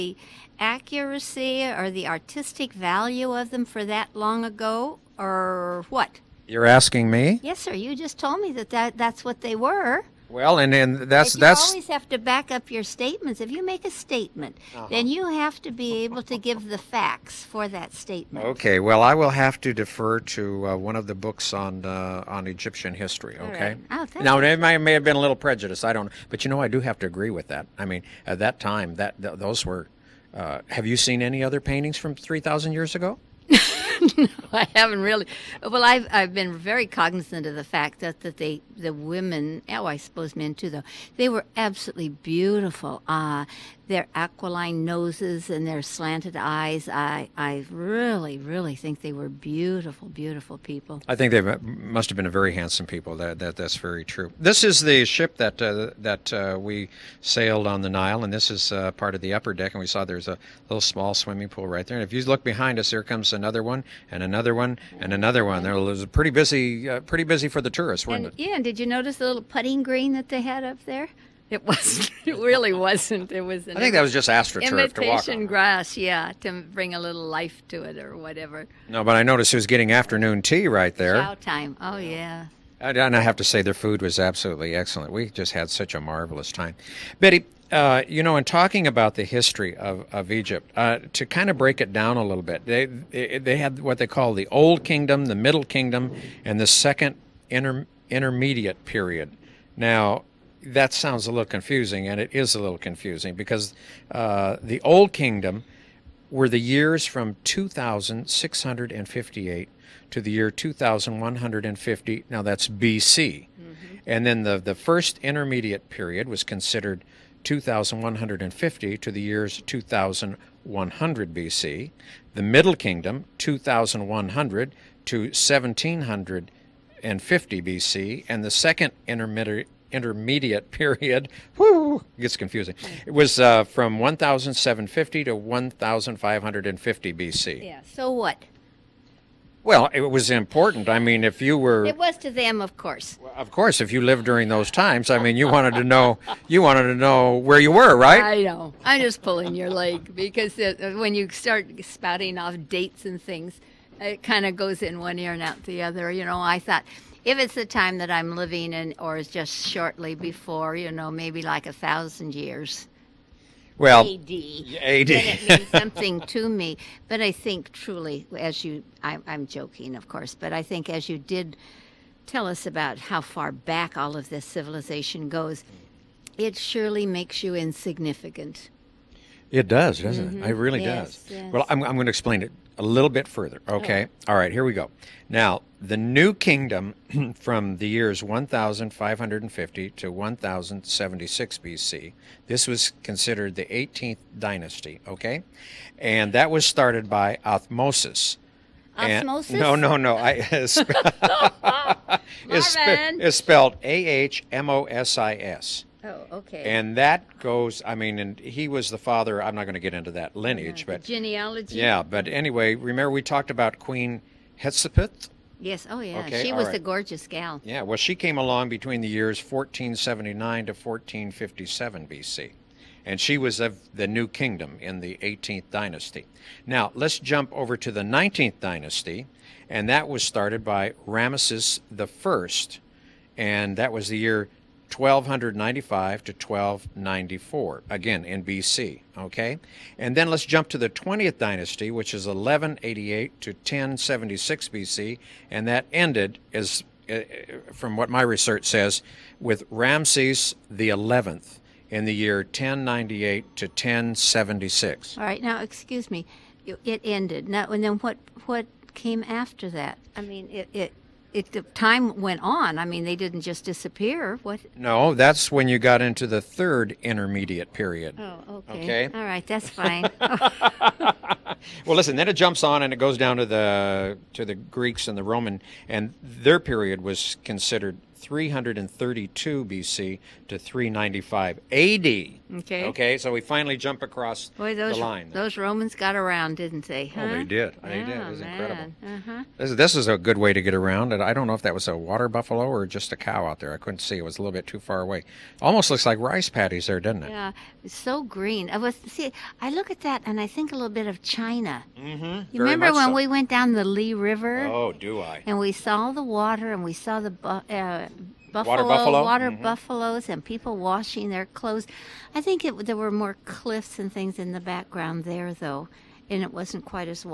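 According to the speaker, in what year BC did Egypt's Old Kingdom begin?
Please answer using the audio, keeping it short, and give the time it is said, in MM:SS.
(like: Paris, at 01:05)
2658, at 01:47.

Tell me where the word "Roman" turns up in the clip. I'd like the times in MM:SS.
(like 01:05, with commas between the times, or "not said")
04:35, 04:45.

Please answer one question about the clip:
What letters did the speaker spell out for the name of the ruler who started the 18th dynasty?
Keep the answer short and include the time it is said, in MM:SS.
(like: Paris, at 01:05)
A H M O S I S, at 03:23.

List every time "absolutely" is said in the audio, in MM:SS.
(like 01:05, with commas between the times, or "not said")
00:41, 01:24.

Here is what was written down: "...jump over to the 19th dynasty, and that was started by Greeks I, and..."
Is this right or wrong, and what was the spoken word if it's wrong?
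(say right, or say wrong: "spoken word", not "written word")
wrong: "Ramesses", not "Greeks".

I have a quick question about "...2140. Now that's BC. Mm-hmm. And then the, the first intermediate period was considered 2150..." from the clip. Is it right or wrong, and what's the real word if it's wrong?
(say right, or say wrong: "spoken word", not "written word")
wrong: "2150", not "2140".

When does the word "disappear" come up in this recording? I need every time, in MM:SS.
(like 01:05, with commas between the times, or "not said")
04:23.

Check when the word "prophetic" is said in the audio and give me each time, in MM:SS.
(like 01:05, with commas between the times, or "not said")
not said.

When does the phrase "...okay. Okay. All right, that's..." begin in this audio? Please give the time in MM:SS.
04:28.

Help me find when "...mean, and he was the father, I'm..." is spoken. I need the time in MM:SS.
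03:27.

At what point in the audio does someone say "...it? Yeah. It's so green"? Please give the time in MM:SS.
04:57.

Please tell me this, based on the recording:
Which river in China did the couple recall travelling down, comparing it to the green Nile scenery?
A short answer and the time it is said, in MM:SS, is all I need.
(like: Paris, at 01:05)
Li River, at 05:03.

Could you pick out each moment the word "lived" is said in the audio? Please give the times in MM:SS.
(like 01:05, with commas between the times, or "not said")
02:24.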